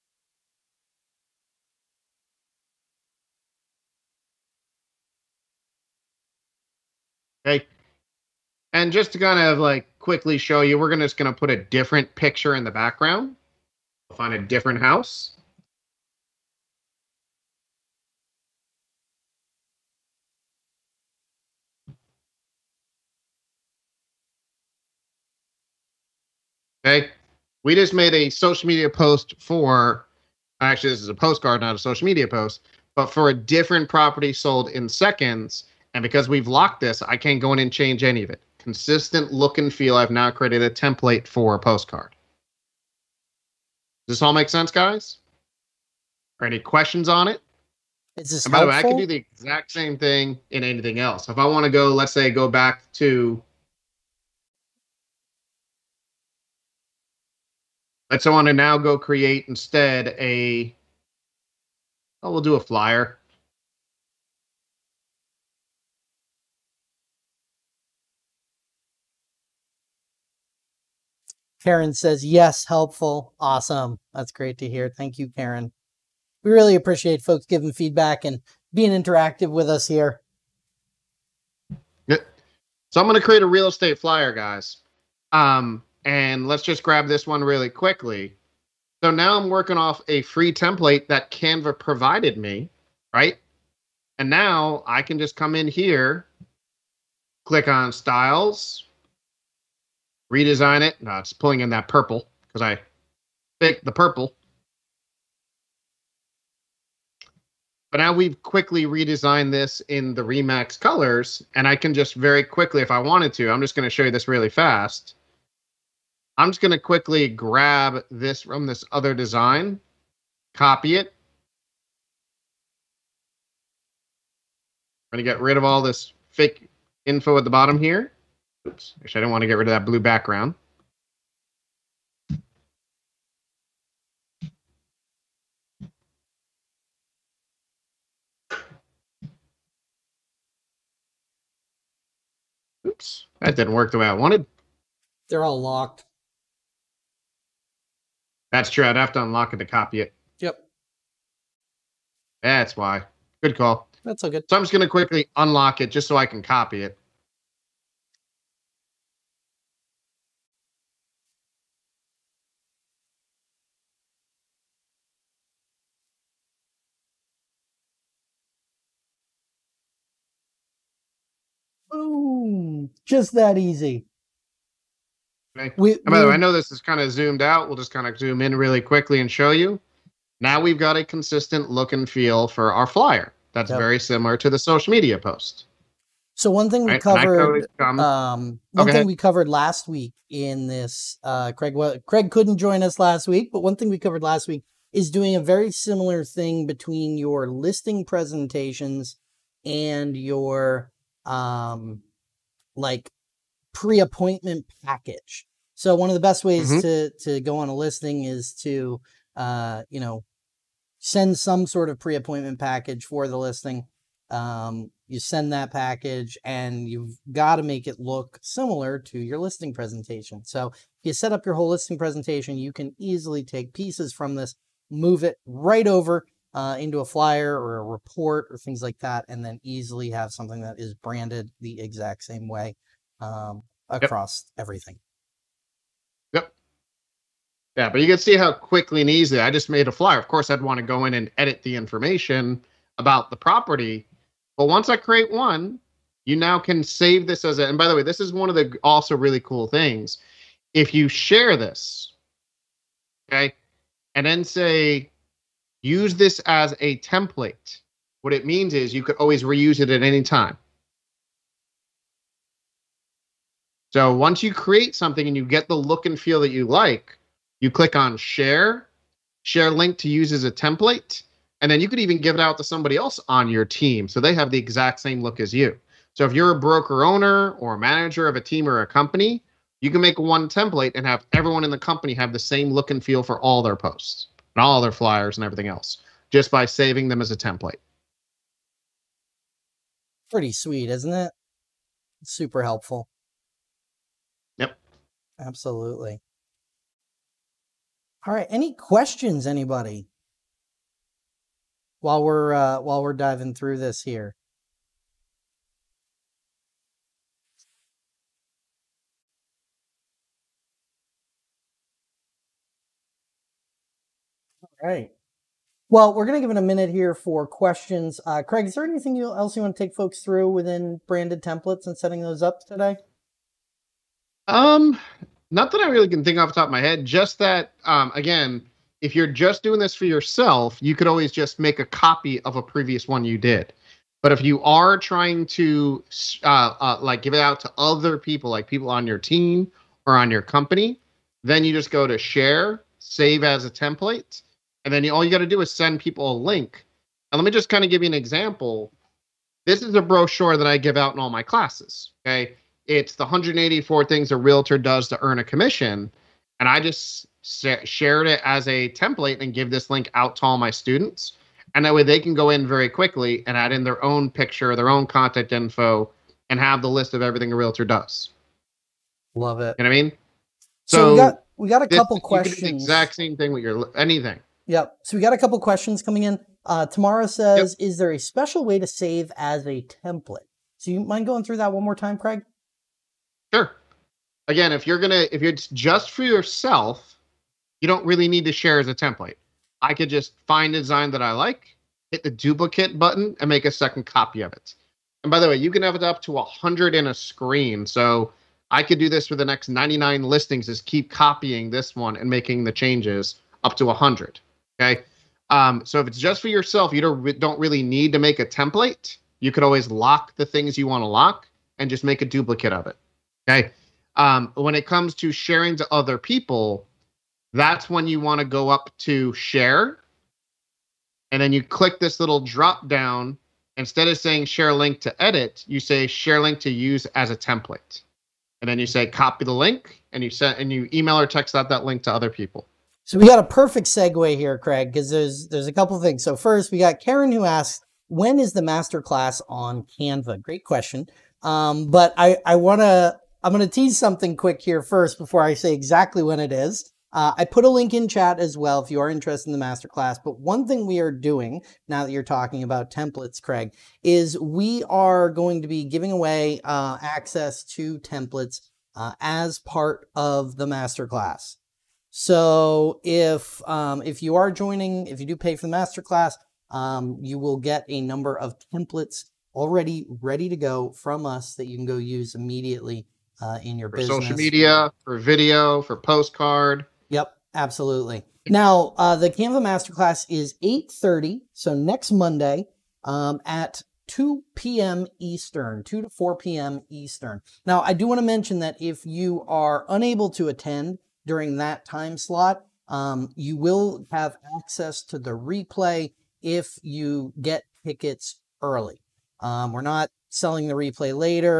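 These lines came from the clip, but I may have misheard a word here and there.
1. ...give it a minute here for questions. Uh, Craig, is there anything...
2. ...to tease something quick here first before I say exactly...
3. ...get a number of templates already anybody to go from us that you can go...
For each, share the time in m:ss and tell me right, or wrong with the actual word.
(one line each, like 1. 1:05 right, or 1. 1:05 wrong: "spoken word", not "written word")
1. 5:16 right
2. 7:23 right
3. 7:47 wrong: "ready", not "anybody".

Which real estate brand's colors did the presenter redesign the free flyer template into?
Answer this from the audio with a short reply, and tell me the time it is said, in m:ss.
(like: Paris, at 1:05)
Remax, at 1:50.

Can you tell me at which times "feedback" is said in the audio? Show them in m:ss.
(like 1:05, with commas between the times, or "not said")
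1:17.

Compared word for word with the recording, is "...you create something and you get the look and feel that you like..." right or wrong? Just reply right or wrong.
right.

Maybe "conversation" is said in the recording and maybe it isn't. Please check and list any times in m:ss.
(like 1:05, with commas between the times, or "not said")
not said.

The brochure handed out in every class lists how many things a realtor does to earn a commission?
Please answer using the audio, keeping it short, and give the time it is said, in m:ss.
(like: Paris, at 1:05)
184, at 5:53.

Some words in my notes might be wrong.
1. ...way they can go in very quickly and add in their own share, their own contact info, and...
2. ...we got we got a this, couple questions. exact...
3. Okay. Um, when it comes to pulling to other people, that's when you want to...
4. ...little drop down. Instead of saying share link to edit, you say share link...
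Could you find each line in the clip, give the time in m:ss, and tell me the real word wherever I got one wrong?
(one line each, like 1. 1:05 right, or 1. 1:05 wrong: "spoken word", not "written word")
1. 6:01 wrong: "picture", not "share"
2. 6:11 right
3. 6:53 wrong: "sharing", not "pulling"
4. 7:02 right.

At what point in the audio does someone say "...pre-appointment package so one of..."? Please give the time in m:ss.
3:23.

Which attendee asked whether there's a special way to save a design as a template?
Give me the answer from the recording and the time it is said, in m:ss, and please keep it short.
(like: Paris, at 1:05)
Tamara, at 6:16.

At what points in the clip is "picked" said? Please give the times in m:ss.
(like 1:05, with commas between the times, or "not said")
1:43.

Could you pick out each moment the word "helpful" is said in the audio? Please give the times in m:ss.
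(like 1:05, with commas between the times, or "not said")
0:48, 1:12, 4:52.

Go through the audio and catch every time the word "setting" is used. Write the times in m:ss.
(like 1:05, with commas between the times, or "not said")
5:21.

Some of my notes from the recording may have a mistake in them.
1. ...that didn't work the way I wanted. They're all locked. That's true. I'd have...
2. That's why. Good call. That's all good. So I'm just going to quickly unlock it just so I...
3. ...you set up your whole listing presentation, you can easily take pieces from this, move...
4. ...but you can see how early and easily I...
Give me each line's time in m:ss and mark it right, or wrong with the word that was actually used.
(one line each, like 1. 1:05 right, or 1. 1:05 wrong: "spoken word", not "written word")
1. 2:23 right
2. 2:32 right
3. 3:41 right
4. 3:57 wrong: "quickly", not "early".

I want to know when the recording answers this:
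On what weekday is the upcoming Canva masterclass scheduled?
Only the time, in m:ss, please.
8:02.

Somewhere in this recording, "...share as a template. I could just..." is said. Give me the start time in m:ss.
6:28.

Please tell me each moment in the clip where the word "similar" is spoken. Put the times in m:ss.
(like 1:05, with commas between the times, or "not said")
3:03, 3:15, 3:38.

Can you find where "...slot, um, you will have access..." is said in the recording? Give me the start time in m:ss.
8:12.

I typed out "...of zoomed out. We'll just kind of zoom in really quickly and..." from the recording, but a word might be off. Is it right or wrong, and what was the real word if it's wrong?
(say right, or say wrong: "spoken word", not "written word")
right.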